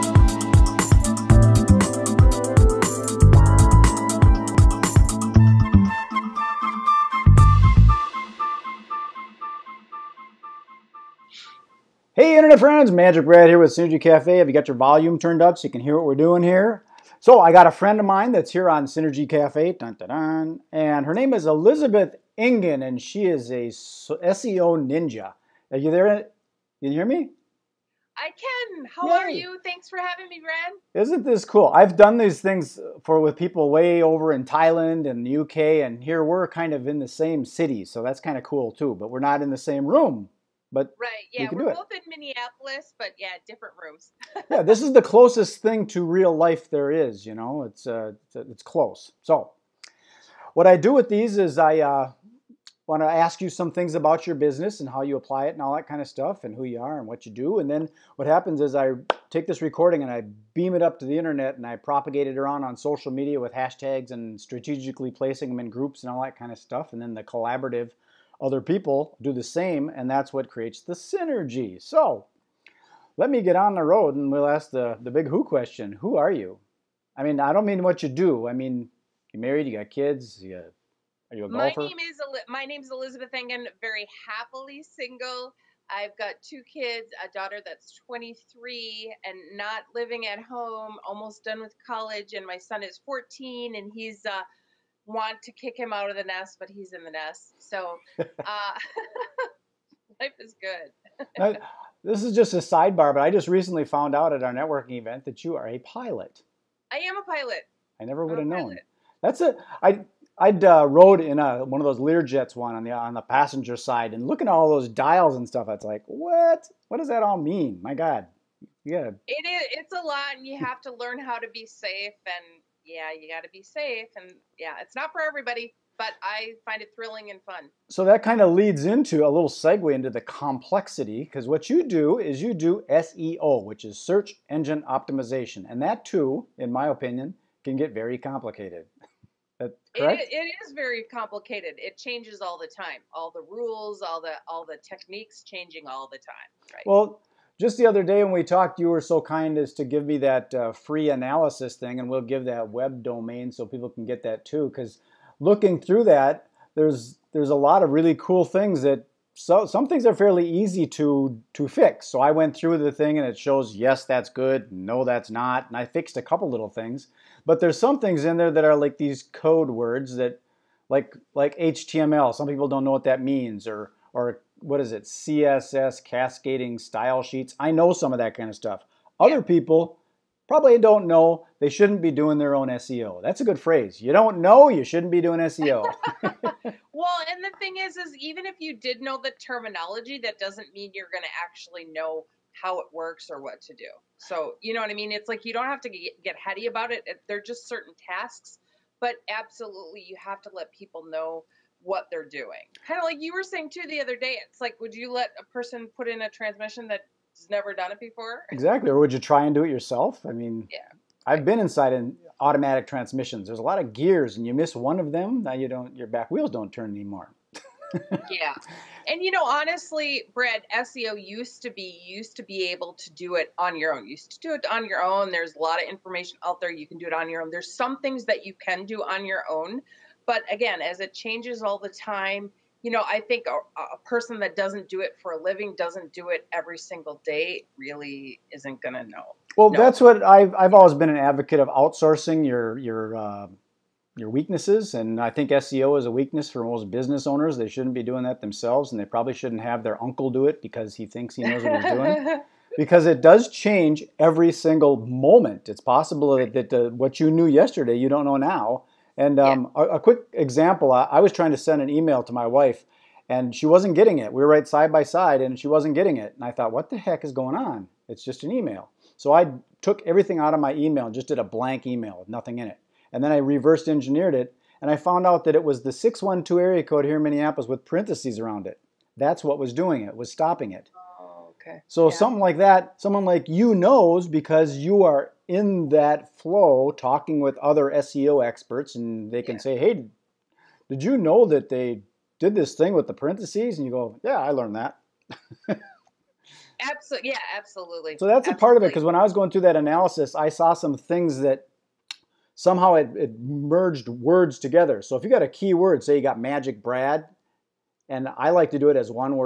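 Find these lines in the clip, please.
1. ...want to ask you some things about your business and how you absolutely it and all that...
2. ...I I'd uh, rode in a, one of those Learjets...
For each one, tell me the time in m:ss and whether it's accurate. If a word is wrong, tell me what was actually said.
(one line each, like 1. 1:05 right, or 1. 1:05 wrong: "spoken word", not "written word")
1. 0:52 wrong: "apply", not "absolutely"
2. 1:49 right.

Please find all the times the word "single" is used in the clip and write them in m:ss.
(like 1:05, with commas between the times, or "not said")
1:24, 3:56, 4:14.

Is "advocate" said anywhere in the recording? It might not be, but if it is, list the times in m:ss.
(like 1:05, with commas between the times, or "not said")
4:01.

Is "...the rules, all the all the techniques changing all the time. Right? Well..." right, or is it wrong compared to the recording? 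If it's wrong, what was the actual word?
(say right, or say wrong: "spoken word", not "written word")
right.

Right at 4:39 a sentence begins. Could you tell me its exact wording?
That's what was doing it, was stopping it.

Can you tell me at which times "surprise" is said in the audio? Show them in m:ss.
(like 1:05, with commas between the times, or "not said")
not said.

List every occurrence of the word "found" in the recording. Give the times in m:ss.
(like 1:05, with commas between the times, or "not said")
1:43, 4:34.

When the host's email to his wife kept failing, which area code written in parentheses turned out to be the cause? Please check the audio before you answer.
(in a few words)
612.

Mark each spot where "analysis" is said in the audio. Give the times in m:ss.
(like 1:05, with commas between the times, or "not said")
2:31, 4:59.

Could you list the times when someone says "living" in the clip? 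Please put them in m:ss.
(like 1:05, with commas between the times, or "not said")
1:29, 3:55.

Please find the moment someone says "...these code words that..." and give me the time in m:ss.
2:48.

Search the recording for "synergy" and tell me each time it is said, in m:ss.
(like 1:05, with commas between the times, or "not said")
0:13, 0:18, 1:10.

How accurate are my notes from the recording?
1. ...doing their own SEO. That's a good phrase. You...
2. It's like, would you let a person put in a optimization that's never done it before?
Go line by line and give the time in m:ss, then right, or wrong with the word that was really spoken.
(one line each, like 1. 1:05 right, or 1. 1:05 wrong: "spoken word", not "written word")
1. 3:02 right
2. 3:24 wrong: "transmission", not "optimization".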